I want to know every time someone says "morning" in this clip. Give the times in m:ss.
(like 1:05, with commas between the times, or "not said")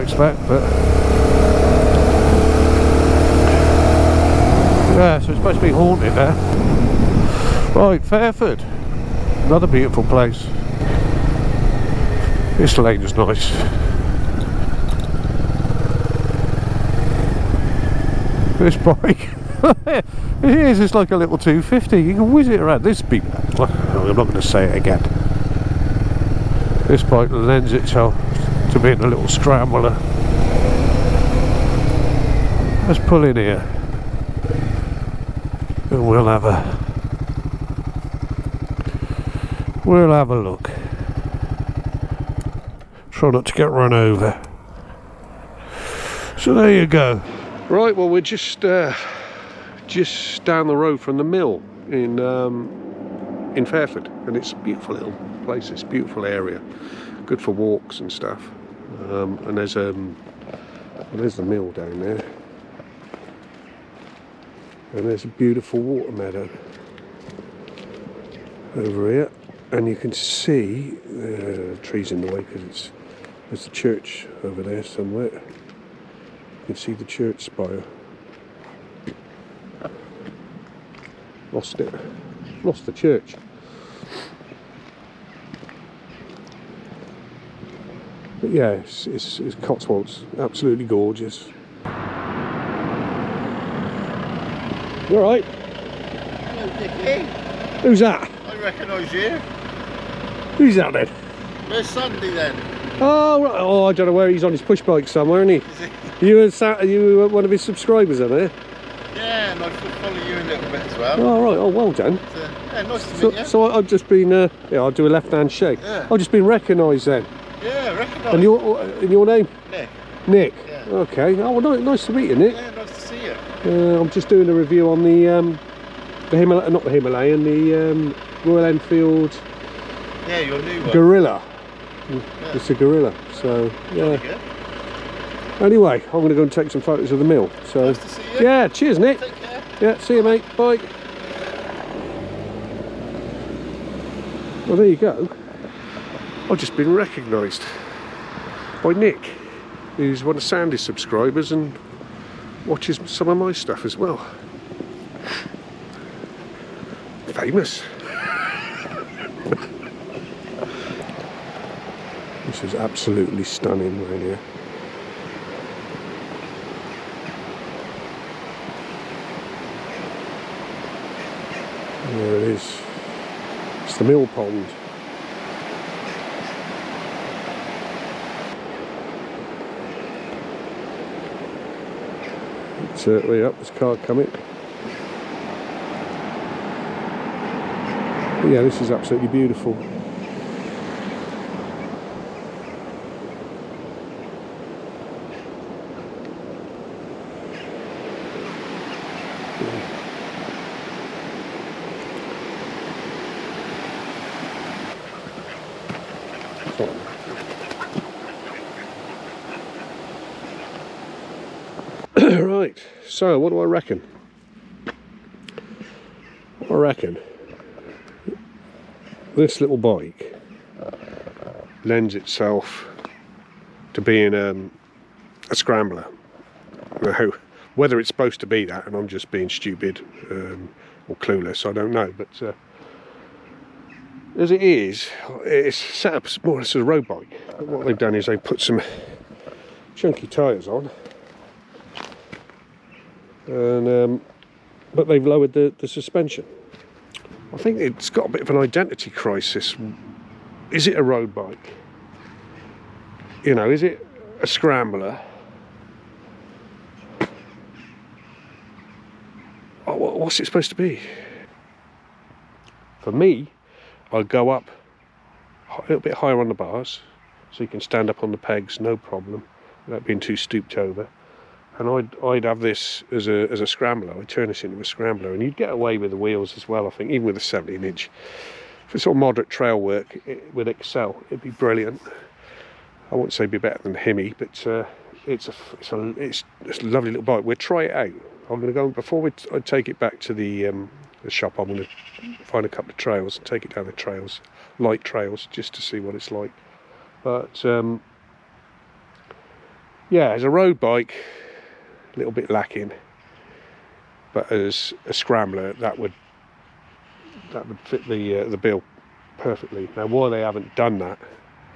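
not said.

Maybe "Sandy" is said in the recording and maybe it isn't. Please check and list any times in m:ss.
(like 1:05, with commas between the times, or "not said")
1:41, 2:30.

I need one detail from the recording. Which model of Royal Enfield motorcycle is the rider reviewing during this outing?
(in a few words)
Guerrilla.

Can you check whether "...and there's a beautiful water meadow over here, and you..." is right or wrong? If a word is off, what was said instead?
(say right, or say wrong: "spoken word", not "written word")
right.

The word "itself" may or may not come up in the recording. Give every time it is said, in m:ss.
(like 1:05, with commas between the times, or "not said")
0:27, 3:42.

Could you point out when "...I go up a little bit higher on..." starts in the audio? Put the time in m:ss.
4:24.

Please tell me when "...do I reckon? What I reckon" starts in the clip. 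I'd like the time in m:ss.
3:33.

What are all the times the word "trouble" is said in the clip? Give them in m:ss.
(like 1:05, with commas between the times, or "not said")
not said.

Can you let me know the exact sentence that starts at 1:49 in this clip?
Yeah, and I follow you a little bit as well.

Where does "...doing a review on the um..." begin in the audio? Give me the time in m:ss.
2:04.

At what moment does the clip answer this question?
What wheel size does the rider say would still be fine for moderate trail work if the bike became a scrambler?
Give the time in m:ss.
4:37.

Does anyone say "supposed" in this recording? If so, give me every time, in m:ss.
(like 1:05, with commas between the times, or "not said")
0:05, 3:48, 4:20.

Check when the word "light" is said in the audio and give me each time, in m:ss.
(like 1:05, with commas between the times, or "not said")
4:54.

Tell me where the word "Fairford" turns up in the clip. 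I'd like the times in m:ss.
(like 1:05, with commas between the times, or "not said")
0:08, 0:53.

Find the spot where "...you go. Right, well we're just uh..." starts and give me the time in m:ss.
0:46.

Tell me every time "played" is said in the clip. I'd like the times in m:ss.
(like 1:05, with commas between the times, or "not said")
not said.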